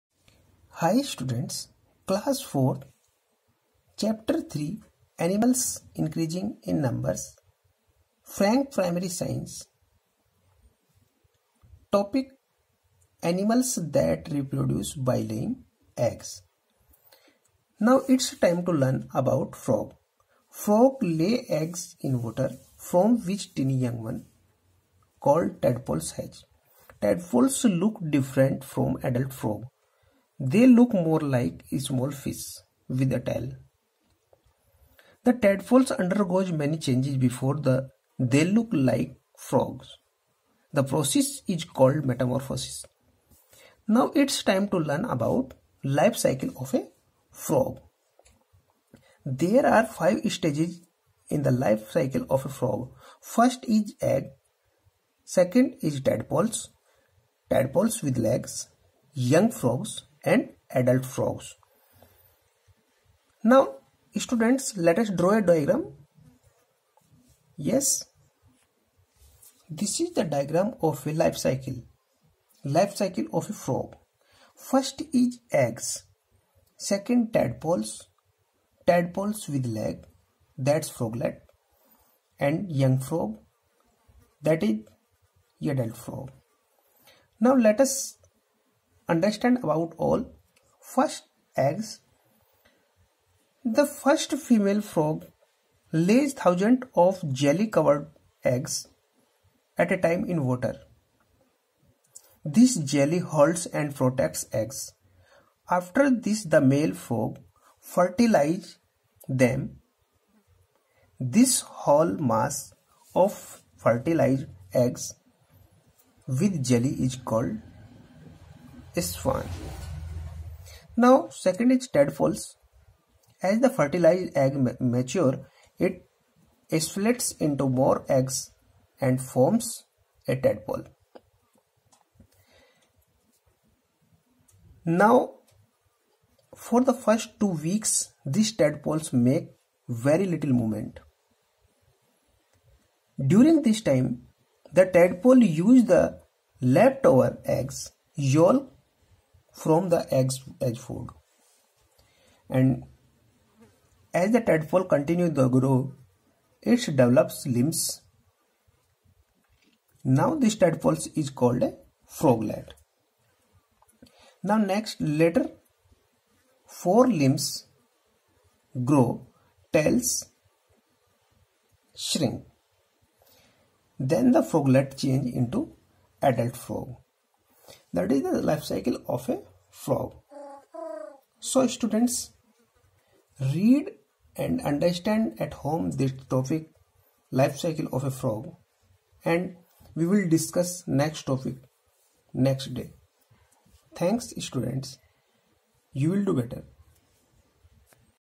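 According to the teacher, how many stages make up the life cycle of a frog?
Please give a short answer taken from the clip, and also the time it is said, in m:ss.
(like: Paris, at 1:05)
5, at 0:49.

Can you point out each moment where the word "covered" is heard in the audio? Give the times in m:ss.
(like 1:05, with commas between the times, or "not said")
1:37.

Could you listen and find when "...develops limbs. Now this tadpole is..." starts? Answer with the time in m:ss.
2:36.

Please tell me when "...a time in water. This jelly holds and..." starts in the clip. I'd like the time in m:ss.
1:39.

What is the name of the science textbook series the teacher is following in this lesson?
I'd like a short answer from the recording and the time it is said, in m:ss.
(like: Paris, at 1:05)
Frank Primary Science, at 0:08.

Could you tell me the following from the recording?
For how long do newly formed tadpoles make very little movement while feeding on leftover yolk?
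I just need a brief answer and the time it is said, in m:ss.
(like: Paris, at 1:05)
2 weeks, at 2:17.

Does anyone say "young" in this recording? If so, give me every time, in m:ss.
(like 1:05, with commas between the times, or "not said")
0:23, 0:59, 1:22.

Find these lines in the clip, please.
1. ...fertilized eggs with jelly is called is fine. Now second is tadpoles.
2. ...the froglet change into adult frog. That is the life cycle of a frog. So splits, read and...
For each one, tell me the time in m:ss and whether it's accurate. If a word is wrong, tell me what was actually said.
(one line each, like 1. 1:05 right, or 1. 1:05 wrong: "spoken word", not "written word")
1. 1:53 right
2. 2:54 wrong: "students", not "splits".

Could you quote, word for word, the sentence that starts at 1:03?
Now students let us draw a diagram.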